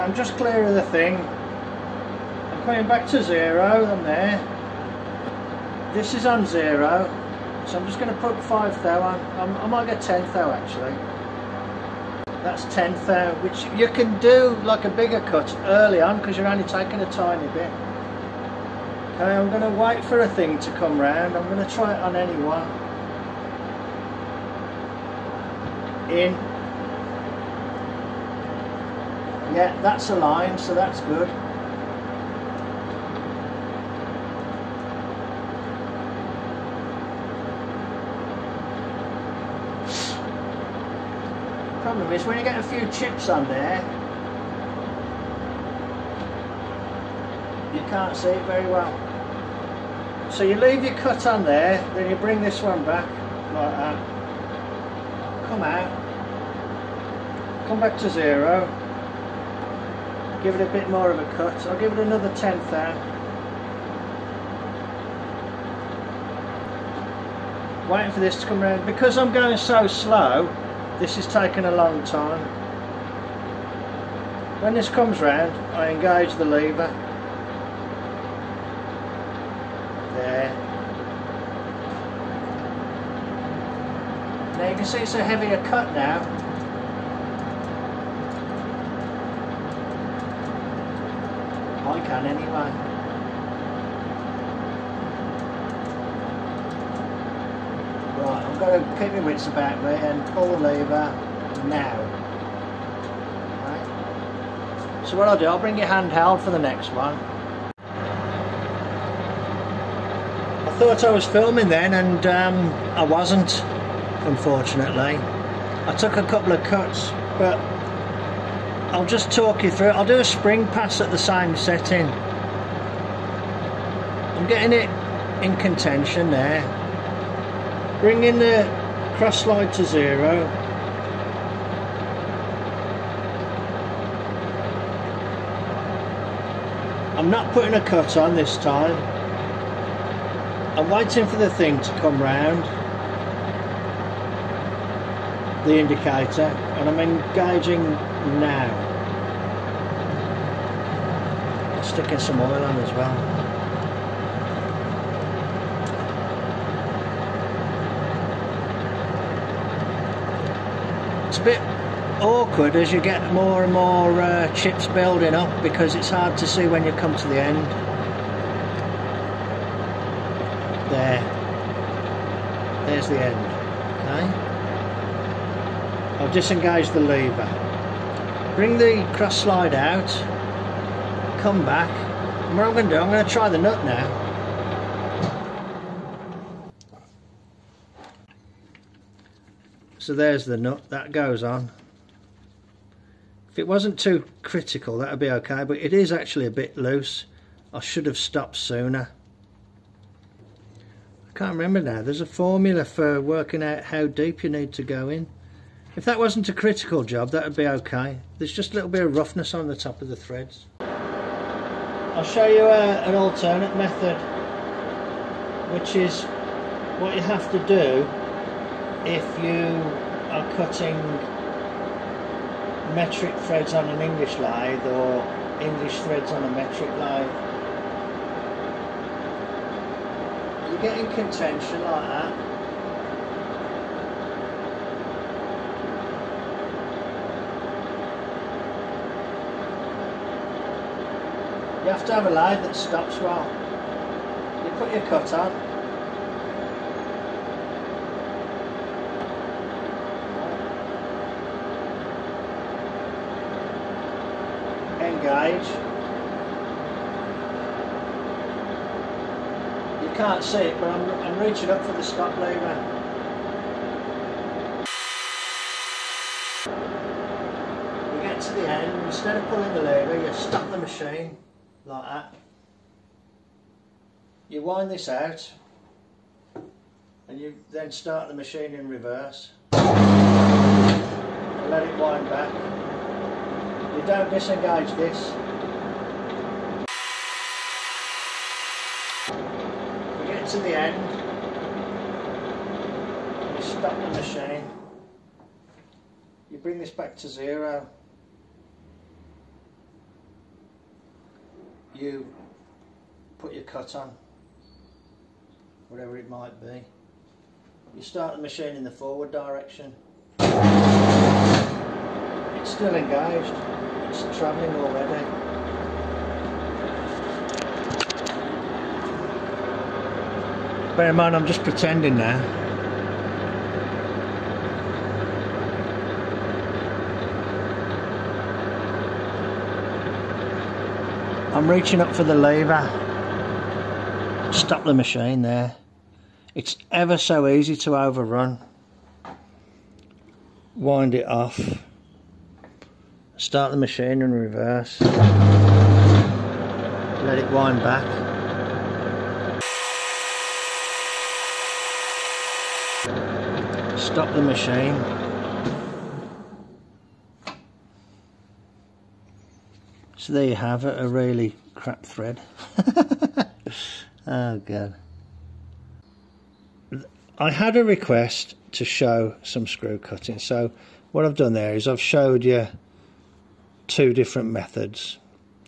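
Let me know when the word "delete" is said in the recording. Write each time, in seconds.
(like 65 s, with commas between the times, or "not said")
not said.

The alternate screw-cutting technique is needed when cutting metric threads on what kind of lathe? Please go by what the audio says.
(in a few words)
English lathe.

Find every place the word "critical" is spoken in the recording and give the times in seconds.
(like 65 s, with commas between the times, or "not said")
194 s, 206 s.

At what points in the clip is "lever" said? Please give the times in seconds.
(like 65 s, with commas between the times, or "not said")
76 s, 100 s, 177 s, 262 s, 269 s, 332 s.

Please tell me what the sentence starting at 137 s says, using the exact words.
I'm not putting a cut on this time.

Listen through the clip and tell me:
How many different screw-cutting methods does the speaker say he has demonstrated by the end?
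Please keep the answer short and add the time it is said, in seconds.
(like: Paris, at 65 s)
2, at 373 s.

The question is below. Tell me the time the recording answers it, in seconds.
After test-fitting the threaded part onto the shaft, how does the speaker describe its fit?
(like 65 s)
196 s.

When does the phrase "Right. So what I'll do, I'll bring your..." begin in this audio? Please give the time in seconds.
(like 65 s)
103 s.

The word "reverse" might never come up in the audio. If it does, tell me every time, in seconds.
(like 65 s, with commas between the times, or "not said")
278 s, 344 s.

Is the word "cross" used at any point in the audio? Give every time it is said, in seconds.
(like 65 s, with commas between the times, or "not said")
129 s, 179 s.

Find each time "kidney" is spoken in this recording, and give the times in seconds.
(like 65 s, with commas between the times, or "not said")
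not said.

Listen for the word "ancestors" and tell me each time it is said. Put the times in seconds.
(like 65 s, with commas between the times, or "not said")
not said.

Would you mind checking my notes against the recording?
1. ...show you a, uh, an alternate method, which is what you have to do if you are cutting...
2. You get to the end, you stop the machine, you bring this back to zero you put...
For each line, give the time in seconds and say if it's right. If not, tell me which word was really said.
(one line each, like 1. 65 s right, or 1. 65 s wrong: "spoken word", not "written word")
1. 212 s right
2. 290 s right.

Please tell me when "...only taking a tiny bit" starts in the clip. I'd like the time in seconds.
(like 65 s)
16 s.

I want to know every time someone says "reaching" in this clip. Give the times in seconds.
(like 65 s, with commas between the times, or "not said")
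261 s, 331 s.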